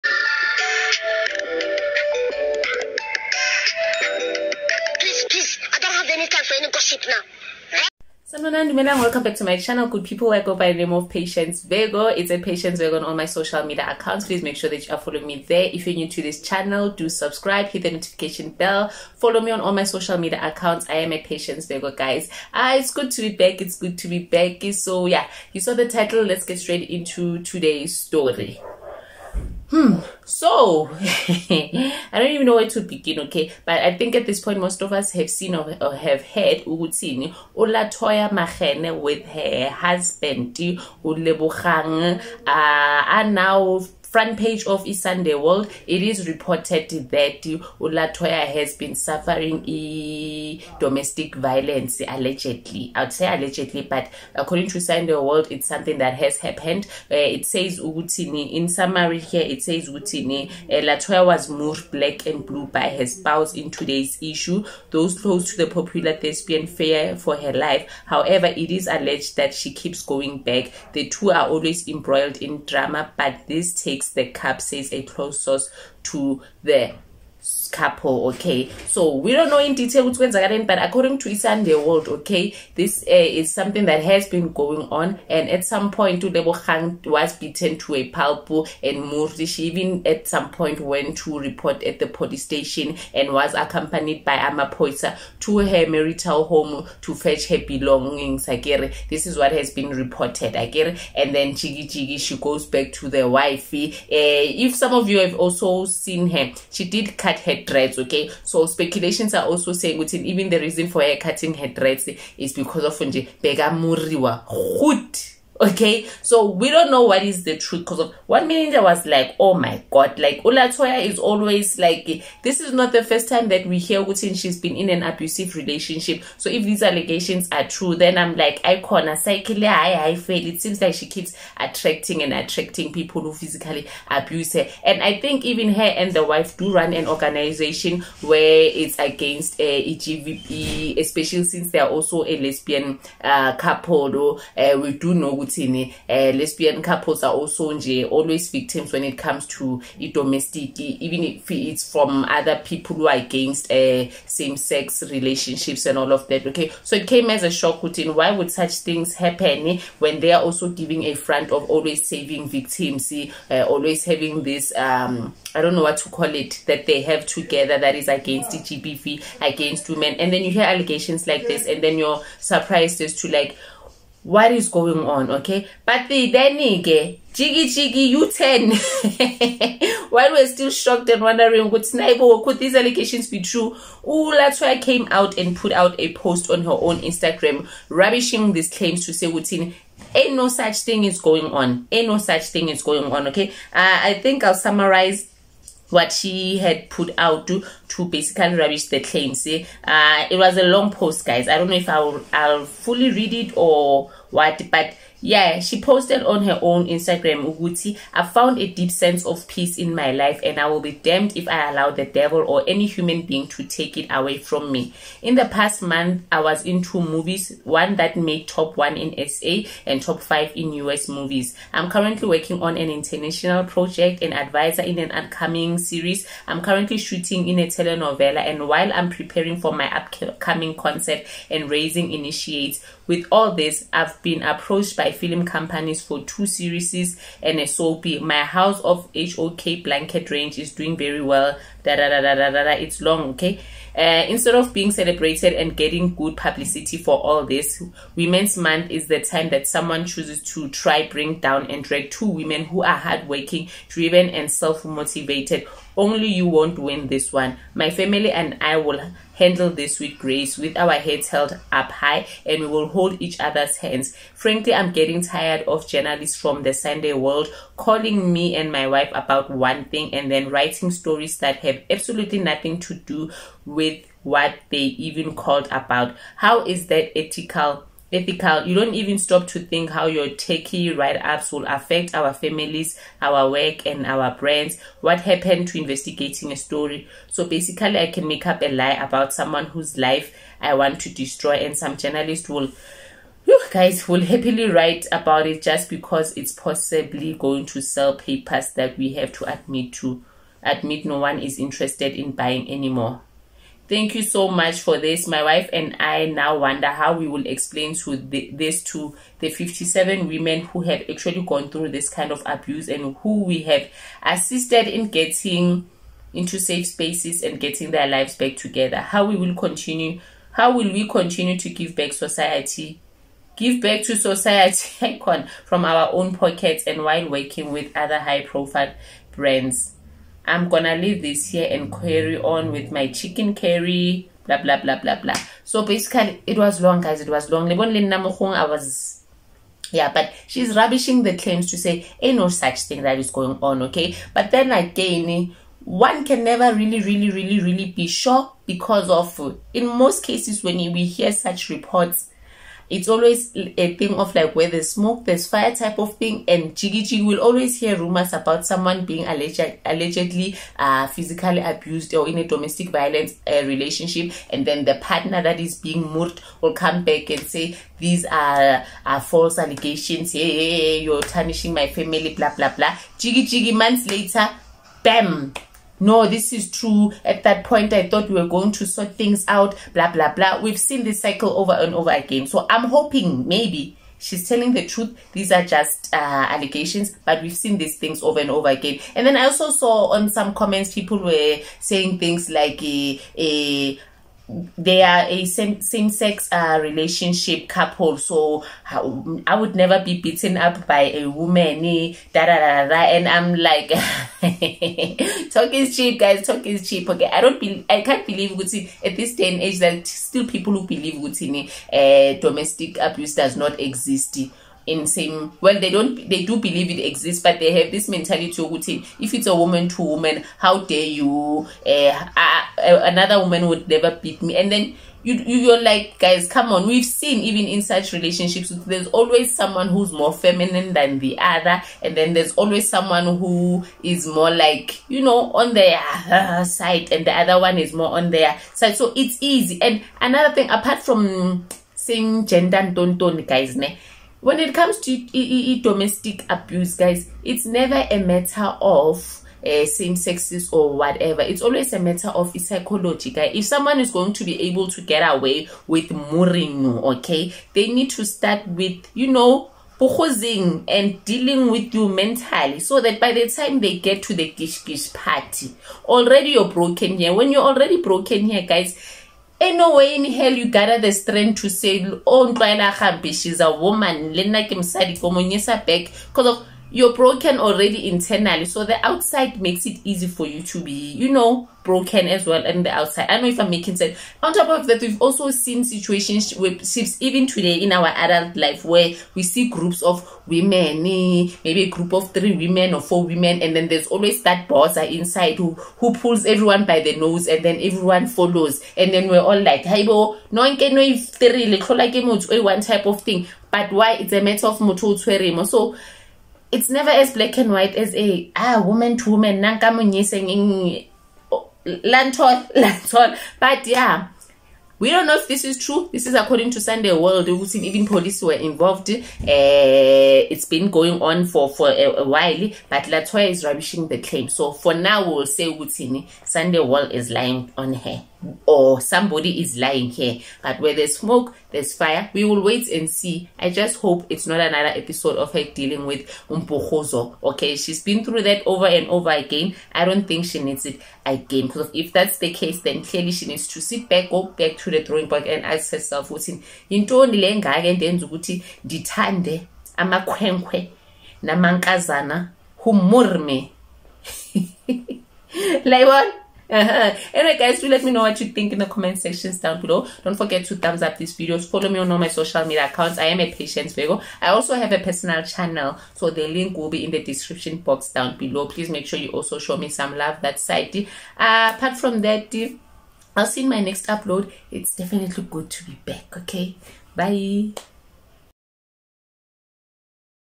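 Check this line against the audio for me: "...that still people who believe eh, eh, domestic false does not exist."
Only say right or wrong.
wrong.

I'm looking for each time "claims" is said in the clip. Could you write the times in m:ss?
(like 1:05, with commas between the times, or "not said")
3:08, 3:19, 5:41, 8:44.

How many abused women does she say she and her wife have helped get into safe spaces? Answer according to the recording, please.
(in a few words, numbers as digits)
57.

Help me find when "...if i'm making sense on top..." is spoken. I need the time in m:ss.
8:03.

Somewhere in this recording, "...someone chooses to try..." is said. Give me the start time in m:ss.
4:09.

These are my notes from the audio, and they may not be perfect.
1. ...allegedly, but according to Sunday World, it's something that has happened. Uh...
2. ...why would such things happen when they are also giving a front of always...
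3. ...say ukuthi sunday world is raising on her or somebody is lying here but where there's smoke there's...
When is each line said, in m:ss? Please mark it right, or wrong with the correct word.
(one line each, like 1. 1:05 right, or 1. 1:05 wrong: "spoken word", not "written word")
1. 0:53 right
2. 2:38 right
3. 8:45 wrong: "lying", not "raising".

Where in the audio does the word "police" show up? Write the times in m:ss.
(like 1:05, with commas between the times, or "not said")
1:32, 8:38.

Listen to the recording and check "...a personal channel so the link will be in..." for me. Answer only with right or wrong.
right.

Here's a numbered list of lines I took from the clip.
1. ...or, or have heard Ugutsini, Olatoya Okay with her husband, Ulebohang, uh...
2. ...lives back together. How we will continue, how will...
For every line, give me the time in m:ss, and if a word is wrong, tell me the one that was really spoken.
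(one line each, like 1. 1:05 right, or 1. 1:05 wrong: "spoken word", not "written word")
1. 0:35 wrong: "Makhene", not "Okay"
2. 5:18 right.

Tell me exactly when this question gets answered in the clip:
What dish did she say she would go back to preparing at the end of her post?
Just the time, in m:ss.
5:33.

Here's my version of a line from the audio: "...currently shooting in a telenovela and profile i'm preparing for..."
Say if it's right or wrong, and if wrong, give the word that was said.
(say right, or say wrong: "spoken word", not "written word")
wrong: "while", not "profile".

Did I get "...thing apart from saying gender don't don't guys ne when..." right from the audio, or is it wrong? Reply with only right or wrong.
right.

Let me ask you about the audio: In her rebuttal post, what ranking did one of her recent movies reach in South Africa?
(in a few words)
top one.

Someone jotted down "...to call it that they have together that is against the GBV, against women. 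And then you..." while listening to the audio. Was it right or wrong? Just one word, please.
right.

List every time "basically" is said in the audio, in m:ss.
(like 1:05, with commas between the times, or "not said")
3:18, 4:47, 5:35.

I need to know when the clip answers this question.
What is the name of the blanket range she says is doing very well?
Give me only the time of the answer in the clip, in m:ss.
3:58.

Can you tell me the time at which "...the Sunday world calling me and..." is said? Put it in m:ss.
4:26.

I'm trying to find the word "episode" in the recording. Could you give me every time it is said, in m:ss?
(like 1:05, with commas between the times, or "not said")
8:55.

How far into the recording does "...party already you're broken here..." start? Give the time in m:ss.
7:45.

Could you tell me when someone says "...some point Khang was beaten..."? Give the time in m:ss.
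1:25.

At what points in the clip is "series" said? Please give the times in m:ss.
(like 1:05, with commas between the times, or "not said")
3:45, 3:56.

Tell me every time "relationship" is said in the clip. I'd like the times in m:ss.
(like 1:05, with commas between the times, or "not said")
2:05, 2:35, 6:03, 6:36, 7:08.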